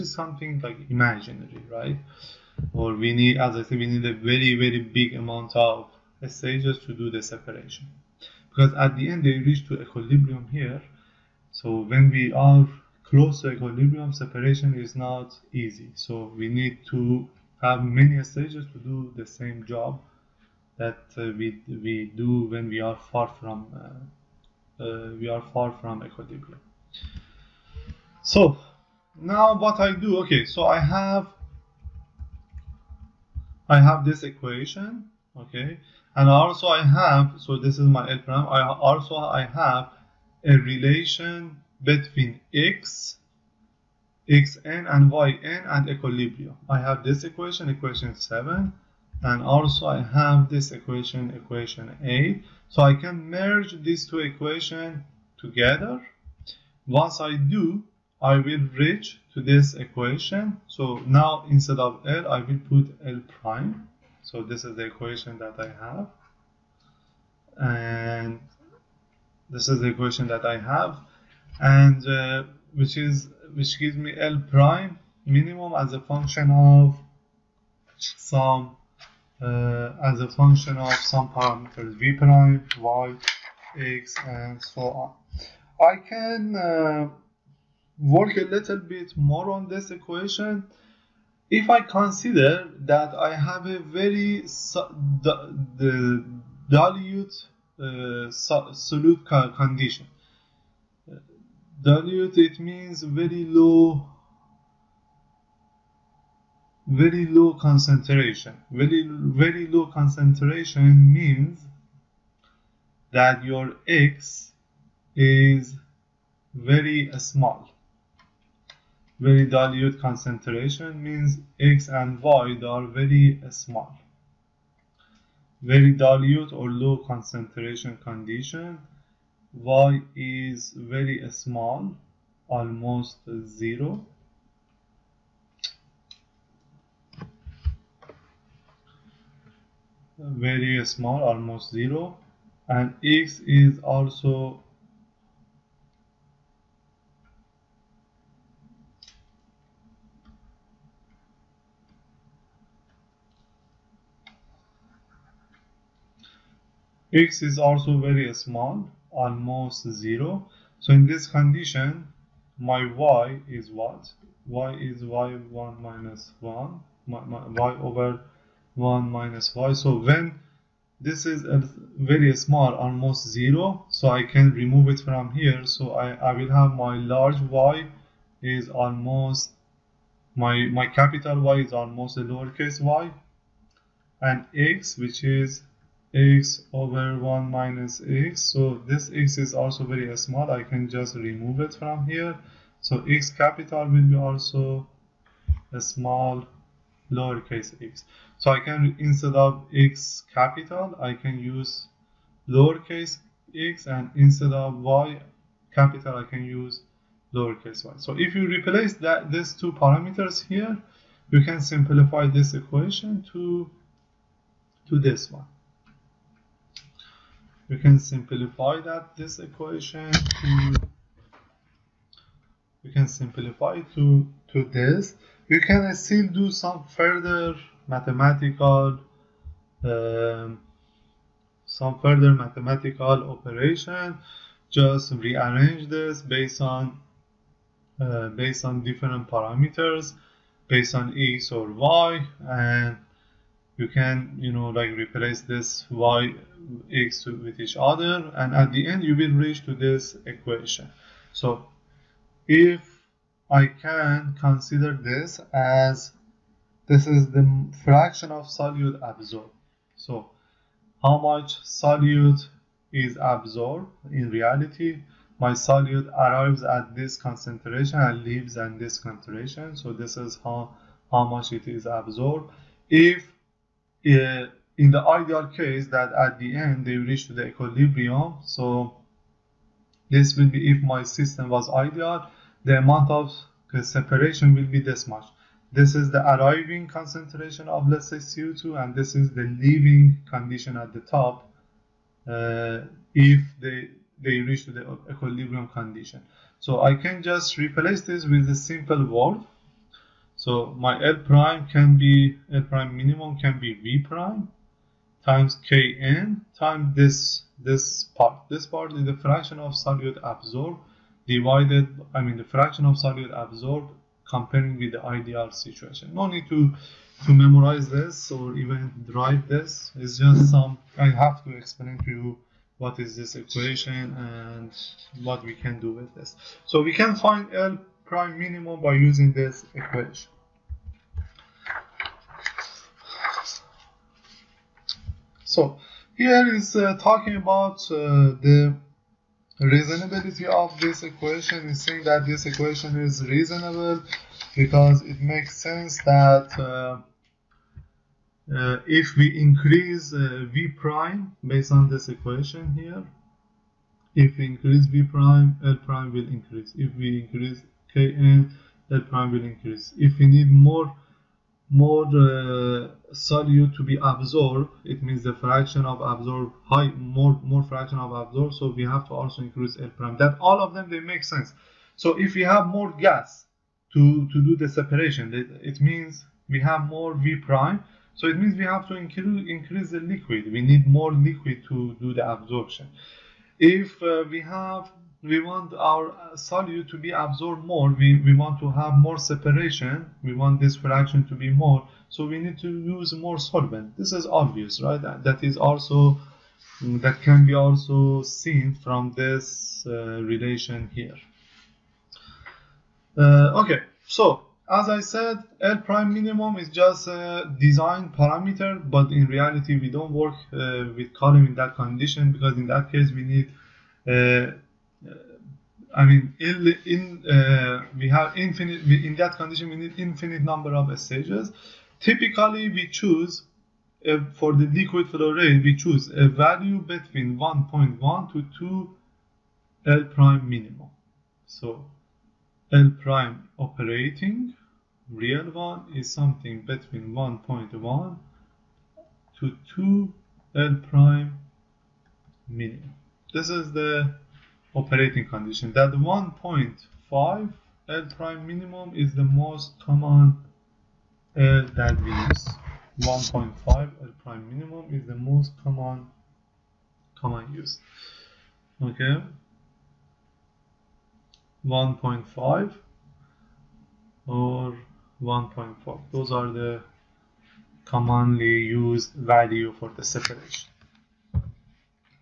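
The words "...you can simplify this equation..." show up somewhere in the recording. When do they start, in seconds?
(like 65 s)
211 s.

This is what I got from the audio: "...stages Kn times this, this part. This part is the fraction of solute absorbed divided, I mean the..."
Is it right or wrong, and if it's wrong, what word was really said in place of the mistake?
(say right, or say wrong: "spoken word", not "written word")
wrong: "times", not "stages".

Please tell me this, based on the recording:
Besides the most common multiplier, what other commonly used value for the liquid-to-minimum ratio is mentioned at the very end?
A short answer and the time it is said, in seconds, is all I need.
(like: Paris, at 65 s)
1.4, at 465 s.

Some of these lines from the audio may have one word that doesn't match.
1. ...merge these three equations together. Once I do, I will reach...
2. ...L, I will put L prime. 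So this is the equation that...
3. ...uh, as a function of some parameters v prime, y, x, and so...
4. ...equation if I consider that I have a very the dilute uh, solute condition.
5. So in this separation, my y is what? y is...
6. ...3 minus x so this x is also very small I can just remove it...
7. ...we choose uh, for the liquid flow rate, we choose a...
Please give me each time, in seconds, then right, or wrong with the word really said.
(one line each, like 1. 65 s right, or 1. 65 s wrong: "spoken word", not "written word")
1. 53 s wrong: "two", not "three"
2. 62 s right
3. 79 s right
4. 89 s right
5. 160 s wrong: "condition", not "separation"
6. 187 s wrong: "1", not "3"
7. 422 s right.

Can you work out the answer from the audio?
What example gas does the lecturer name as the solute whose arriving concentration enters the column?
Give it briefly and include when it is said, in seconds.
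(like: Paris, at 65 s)
CO2, at 288 s.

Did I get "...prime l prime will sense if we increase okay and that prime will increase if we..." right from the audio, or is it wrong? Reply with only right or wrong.
wrong.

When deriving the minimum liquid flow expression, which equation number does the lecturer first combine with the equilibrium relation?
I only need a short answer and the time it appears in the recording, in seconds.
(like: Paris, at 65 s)
equation 7, at 47 s.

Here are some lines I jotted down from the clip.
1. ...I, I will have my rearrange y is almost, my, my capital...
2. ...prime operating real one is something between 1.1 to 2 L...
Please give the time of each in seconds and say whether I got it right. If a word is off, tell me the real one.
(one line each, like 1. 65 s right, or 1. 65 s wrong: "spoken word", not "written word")
1. 175 s wrong: "large", not "rearrange"
2. 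433 s right.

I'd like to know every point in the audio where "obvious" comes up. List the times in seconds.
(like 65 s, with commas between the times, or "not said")
394 s.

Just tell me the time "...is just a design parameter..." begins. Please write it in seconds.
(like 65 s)
406 s.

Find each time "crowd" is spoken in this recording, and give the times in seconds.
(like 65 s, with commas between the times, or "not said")
not said.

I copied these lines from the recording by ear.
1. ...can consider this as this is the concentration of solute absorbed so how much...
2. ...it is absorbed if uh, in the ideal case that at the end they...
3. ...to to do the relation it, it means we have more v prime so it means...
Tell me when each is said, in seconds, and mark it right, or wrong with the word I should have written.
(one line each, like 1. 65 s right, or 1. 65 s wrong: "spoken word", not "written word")
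1. 253 s wrong: "fraction", not "concentration"
2. 271 s right
3. 373 s wrong: "separation", not "relation".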